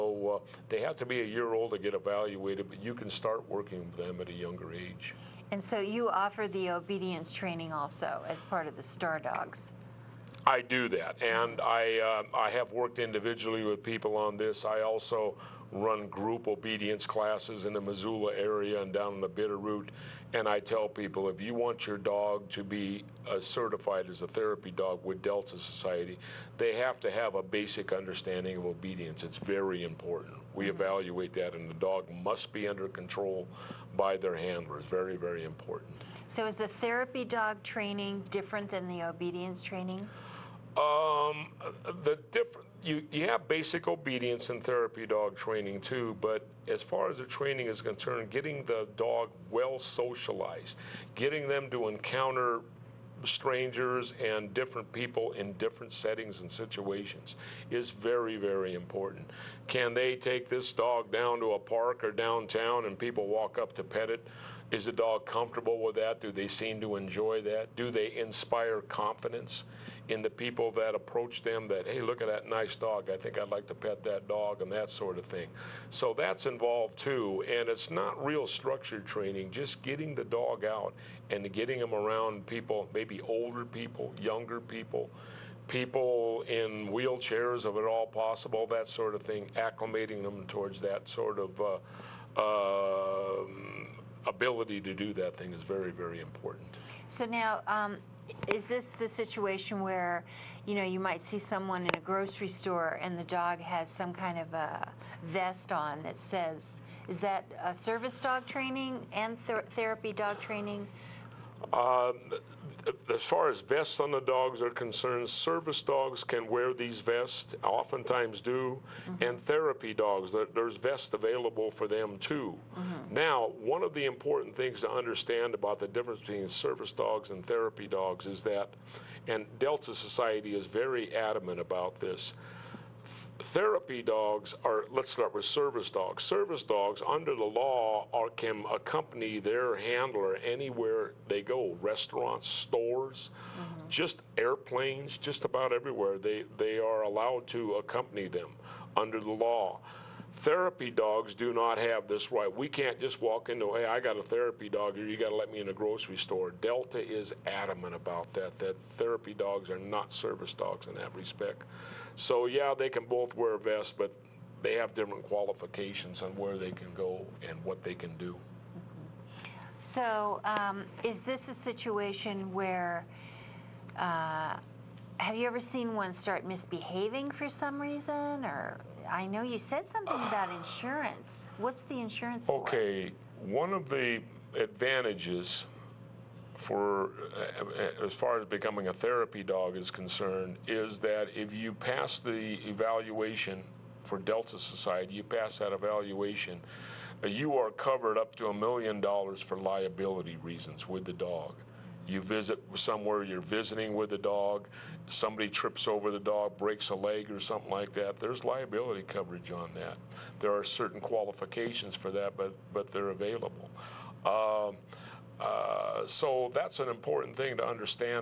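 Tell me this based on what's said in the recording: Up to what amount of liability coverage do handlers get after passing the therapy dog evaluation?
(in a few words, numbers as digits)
a million dollars.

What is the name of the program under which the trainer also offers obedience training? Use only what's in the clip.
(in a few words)
Star Dogs.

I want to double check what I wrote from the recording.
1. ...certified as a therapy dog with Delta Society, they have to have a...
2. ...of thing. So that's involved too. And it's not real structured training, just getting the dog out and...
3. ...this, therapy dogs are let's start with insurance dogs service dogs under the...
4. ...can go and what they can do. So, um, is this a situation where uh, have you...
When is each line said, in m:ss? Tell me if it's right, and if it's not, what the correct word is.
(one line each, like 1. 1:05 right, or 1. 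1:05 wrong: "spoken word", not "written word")
1. 0:23 right
2. 1:15 right
3. 2:11 wrong: "service", not "insurance"
4. 2:46 right.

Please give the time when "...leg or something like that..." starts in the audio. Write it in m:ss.
3:26.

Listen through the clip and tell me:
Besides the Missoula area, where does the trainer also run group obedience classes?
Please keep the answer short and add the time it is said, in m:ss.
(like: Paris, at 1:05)
the Bitterroot, at 0:19.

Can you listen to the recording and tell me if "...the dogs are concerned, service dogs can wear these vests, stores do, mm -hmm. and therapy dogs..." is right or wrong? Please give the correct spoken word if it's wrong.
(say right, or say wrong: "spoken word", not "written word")
wrong: "oftentimes", not "stores".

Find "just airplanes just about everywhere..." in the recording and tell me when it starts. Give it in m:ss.
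2:23.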